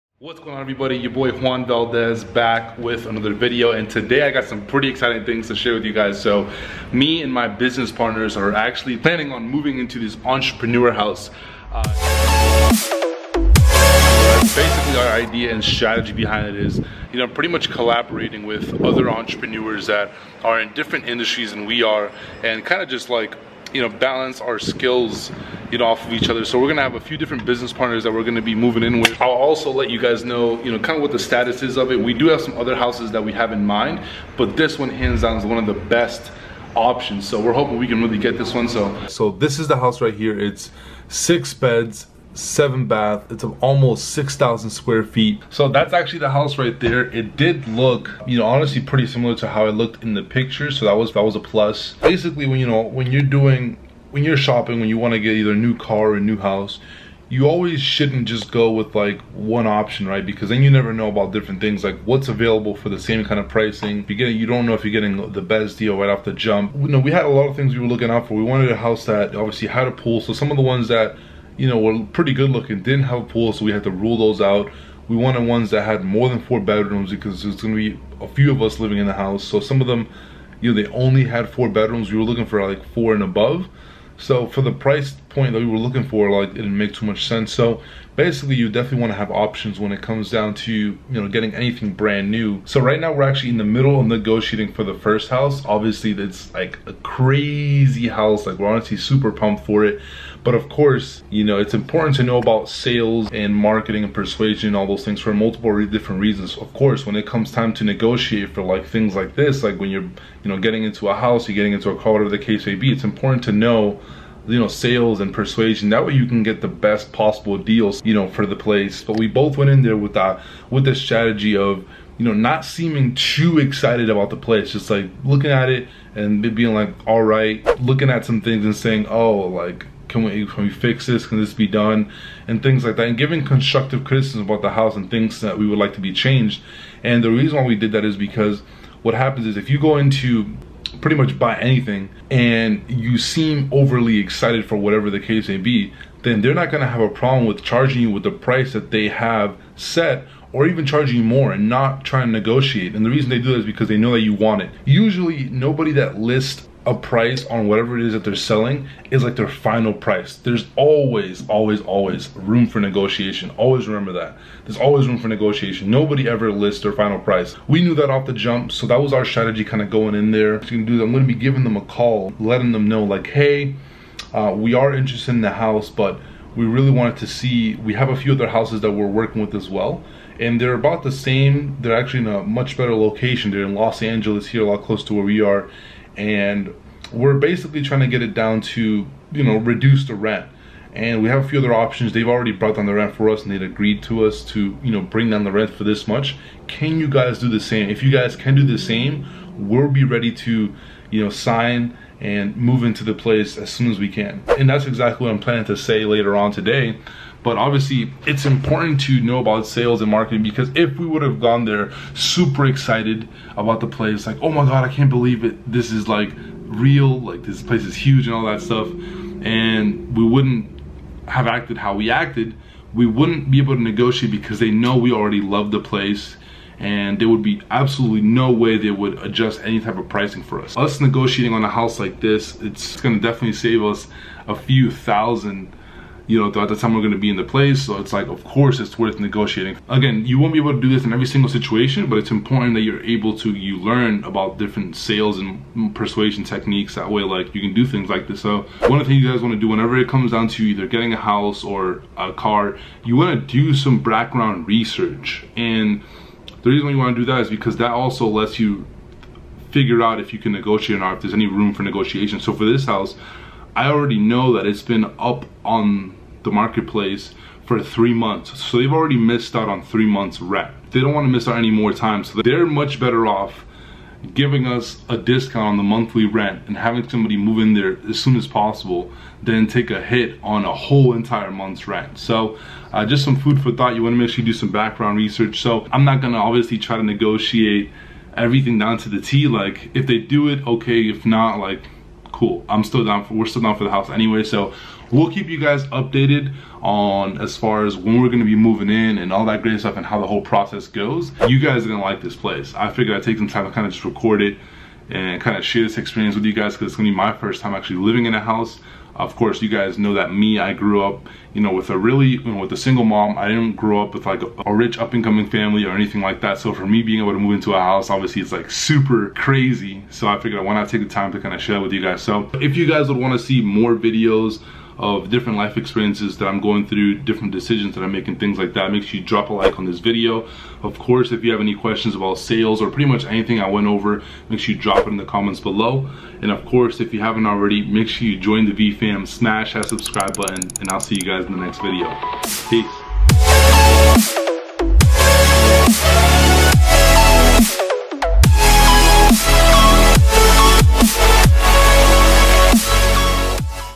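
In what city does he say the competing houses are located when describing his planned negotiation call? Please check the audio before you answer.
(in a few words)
Los Angeles.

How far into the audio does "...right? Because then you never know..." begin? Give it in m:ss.
1:00.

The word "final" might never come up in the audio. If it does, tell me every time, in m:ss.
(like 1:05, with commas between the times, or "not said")
2:39, 2:46.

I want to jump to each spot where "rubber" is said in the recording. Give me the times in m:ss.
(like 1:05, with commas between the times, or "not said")
not said.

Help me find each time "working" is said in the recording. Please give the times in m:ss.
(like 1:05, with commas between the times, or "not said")
2:59.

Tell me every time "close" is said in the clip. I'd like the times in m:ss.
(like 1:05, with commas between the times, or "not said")
3:04.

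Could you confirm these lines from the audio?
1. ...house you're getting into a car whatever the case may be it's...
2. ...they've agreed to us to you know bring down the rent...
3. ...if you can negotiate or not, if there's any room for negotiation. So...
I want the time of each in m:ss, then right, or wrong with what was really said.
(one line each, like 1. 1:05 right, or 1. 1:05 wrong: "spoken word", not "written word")
1. 1:51 right
2. 3:13 right
3. 4:20 right.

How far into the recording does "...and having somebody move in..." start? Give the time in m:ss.
4:36.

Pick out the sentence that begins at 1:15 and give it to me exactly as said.
We wanted ones that had more than four bedrooms because there's going to be a few of us living in the house.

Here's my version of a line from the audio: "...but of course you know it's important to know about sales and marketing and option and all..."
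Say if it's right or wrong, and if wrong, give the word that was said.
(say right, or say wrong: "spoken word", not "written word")
wrong: "persuasion", not "option".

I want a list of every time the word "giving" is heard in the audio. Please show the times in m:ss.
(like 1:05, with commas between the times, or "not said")
2:13, 2:51, 4:34.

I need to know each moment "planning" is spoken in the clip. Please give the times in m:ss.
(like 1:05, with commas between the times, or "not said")
0:08, 3:25.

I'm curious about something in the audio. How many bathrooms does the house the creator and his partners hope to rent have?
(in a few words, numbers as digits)
7.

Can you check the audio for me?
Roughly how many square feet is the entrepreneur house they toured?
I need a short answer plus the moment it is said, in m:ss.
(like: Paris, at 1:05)
almost 6,000, at 0:43.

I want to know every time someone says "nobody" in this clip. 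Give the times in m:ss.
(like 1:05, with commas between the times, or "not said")
2:35, 2:45.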